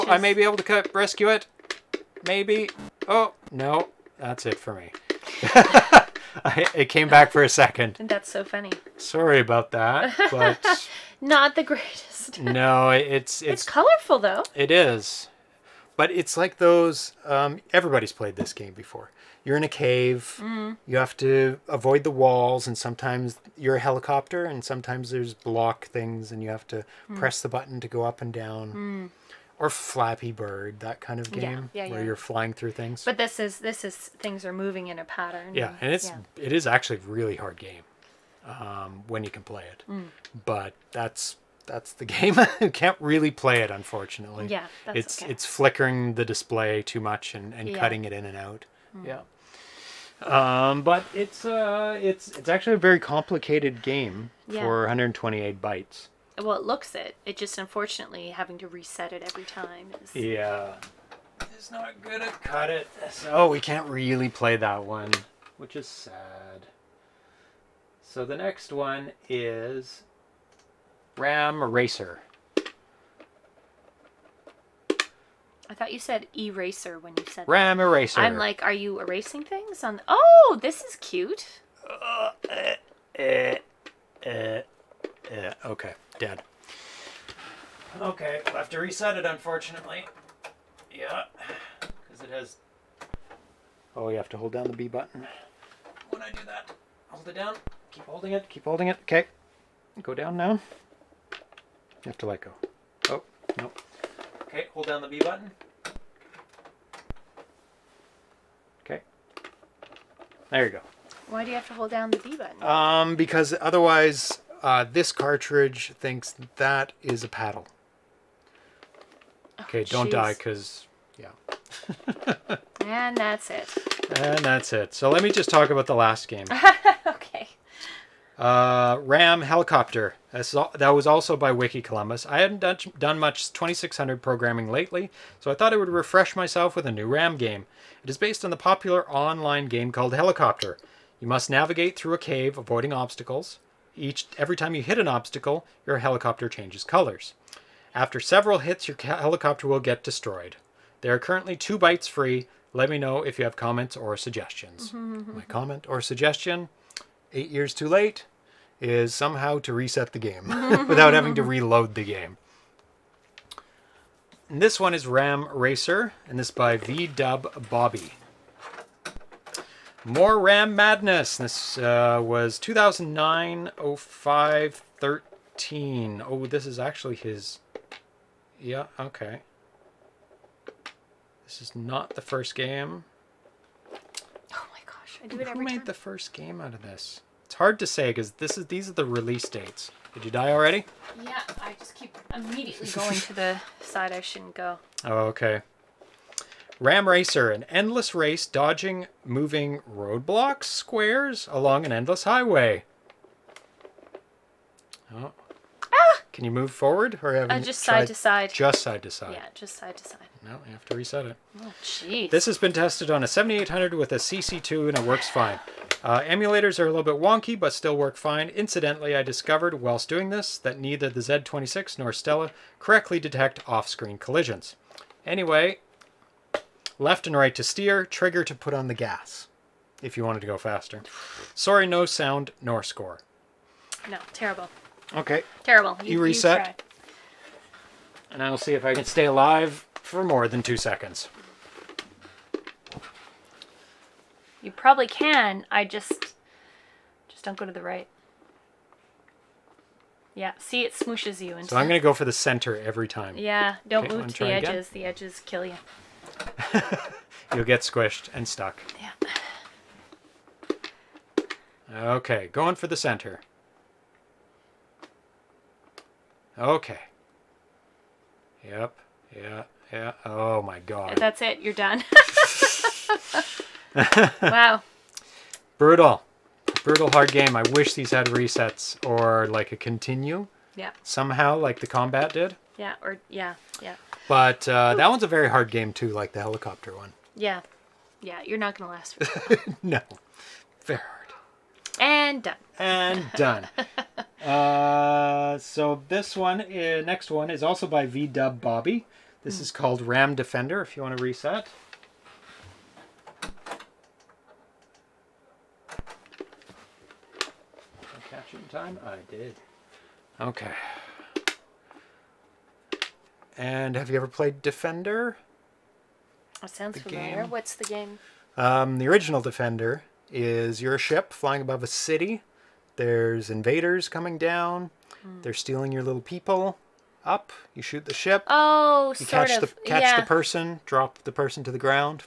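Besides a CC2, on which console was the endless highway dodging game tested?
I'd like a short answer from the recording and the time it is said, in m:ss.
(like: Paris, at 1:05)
7800, at 3:33.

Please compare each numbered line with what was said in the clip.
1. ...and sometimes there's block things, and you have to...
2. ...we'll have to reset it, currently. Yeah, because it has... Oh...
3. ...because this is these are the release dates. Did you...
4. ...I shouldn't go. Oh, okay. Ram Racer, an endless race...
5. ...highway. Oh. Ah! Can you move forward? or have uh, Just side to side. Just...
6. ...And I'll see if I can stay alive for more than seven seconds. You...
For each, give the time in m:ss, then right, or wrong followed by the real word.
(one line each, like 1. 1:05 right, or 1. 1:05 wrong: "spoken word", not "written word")
1. 0:24 right
2. 1:28 wrong: "unfortunately", not "currently"
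3. 3:08 right
4. 3:14 right
5. 3:22 right
6. 3:58 wrong: "two", not "seven".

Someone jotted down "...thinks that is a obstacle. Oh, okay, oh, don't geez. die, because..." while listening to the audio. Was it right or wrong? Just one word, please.
wrong.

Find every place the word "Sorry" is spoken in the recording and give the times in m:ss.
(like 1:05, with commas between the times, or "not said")
0:08, 3:51.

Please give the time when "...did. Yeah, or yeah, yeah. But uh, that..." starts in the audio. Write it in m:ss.
4:42.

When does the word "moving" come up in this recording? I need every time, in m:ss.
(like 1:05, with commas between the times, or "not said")
0:34, 3:19.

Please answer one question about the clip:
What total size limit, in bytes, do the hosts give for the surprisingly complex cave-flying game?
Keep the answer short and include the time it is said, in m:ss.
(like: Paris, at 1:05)
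128, at 0:54.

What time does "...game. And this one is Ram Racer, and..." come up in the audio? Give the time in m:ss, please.
2:42.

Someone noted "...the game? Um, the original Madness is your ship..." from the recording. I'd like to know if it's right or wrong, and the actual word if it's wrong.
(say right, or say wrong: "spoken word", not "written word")
wrong: "Defender", not "Madness".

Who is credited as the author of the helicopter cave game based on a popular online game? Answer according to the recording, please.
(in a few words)
Wickeycolumbus.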